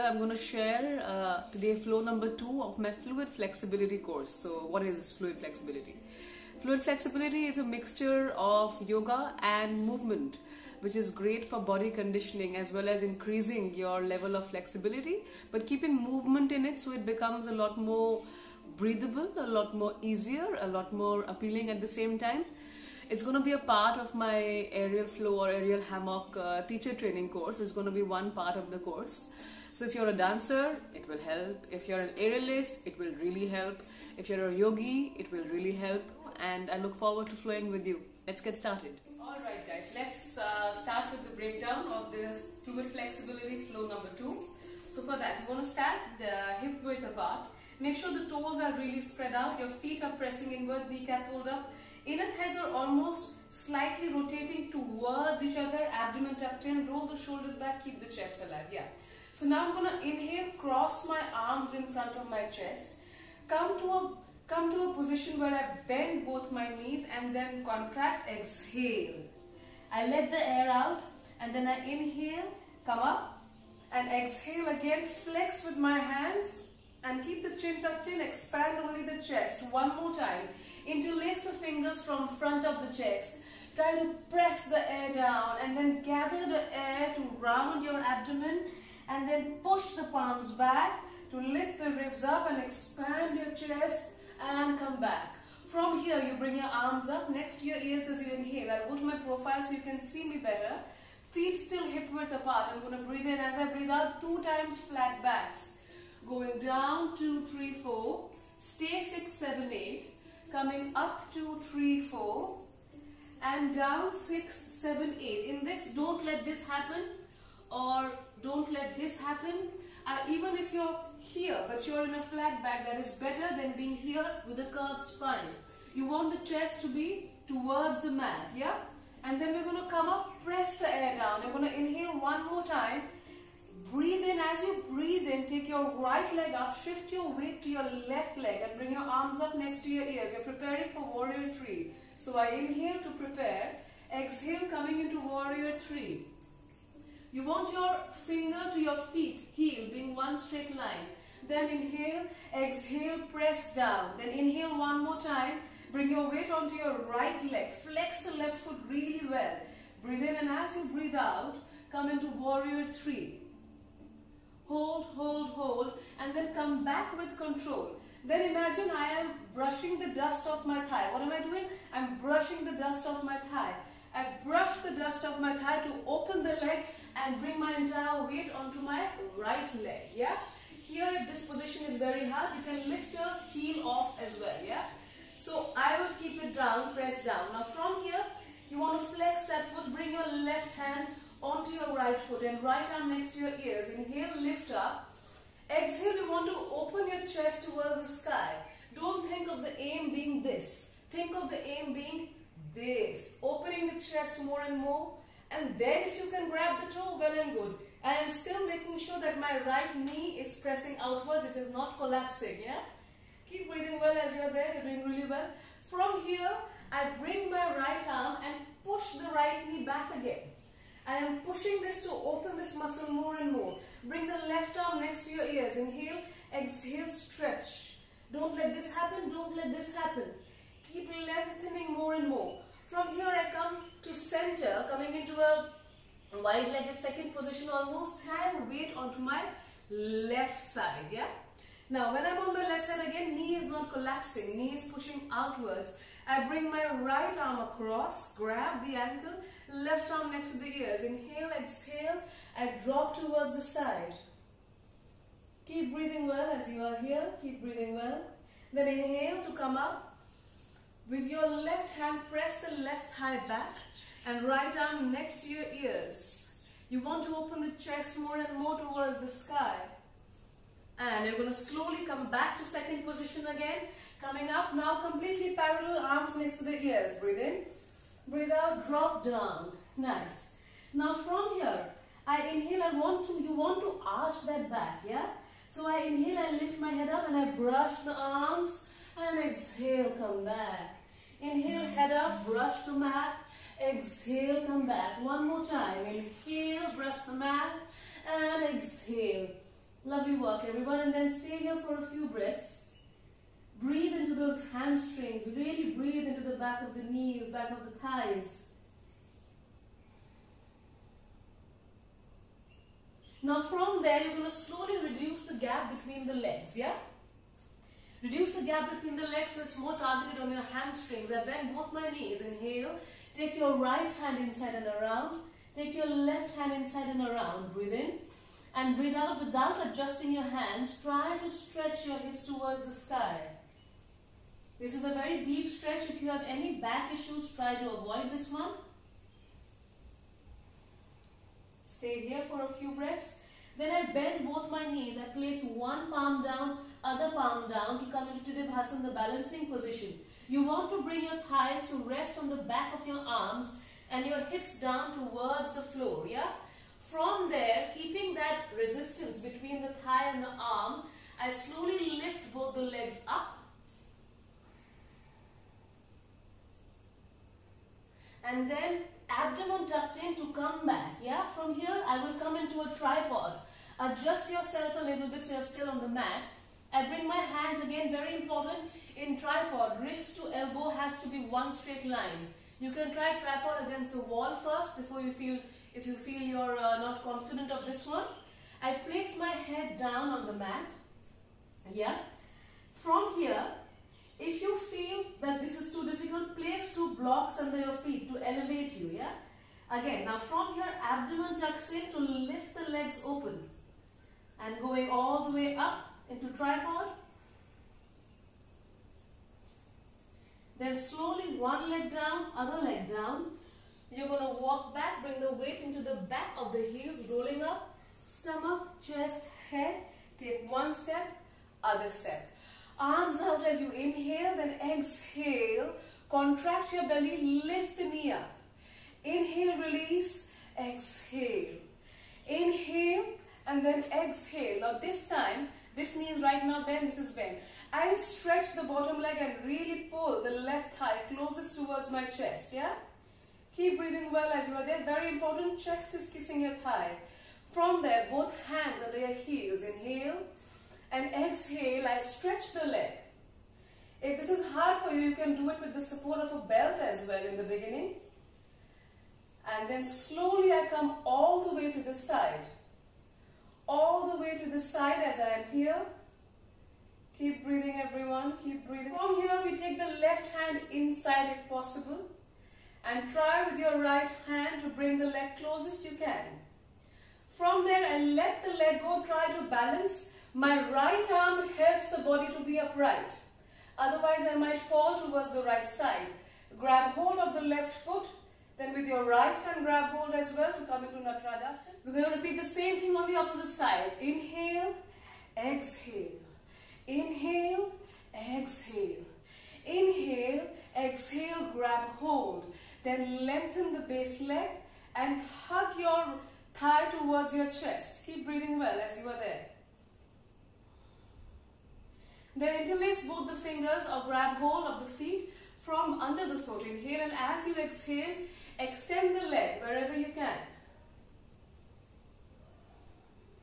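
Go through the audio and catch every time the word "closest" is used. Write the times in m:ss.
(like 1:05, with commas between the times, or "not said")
7:21, 7:55.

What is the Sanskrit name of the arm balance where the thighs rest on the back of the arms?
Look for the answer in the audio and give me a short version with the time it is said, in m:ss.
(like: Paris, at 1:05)
Tittibhasana, at 5:48.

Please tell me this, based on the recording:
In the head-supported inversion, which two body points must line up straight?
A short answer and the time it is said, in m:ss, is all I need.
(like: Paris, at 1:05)
Wrist to elbow, at 6:20.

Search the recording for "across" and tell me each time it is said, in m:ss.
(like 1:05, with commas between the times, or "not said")
4:07.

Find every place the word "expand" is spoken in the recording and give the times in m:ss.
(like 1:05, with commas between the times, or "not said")
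1:18, 1:32.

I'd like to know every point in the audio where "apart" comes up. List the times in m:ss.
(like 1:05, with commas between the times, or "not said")
0:47, 1:42.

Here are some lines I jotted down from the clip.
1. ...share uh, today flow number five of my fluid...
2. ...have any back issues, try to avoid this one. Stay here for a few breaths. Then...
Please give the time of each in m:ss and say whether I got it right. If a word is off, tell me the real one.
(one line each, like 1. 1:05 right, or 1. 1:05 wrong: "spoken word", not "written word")
1. 0:00 wrong: "two", not "five"
2. 5:36 right.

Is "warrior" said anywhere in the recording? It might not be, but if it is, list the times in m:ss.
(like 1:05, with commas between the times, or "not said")
2:21, 2:25, 2:42.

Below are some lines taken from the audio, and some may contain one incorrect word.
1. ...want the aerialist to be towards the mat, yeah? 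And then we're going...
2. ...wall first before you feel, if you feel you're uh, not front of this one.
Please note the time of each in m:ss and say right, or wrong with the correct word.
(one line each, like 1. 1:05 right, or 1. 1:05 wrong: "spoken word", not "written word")
1. 2:06 wrong: "chest", not "aerialist"
2. 6:24 wrong: "confident", not "front".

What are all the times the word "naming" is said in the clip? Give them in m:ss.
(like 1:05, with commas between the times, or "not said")
not said.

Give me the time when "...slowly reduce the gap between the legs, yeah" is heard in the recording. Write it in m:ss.
5:14.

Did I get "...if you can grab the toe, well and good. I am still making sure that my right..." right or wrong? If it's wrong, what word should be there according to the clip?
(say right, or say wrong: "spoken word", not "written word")
right.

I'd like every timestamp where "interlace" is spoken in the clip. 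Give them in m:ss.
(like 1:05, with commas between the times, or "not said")
1:20, 8:32.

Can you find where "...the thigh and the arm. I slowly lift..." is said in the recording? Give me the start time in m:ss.
5:59.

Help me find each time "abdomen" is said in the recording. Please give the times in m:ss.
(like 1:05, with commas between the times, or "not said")
0:55, 1:27, 6:09, 6:41.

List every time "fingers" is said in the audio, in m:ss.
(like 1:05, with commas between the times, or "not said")
1:21, 2:28, 8:33.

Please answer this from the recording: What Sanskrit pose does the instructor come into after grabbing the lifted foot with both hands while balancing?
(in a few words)
Natarajasana.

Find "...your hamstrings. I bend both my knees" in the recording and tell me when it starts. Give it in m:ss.
5:20.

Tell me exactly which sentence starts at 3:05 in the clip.
So, I will keep it down, press down.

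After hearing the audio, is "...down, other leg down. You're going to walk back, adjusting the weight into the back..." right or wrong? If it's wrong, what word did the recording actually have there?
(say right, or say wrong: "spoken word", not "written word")
wrong: "bring", not "adjusting".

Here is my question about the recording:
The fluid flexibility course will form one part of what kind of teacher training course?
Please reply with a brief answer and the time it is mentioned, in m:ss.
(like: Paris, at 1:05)
Aerial hammock, at 0:25.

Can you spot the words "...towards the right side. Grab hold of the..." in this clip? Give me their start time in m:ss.
8:05.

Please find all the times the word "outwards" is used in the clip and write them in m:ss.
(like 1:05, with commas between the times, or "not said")
3:31, 4:05.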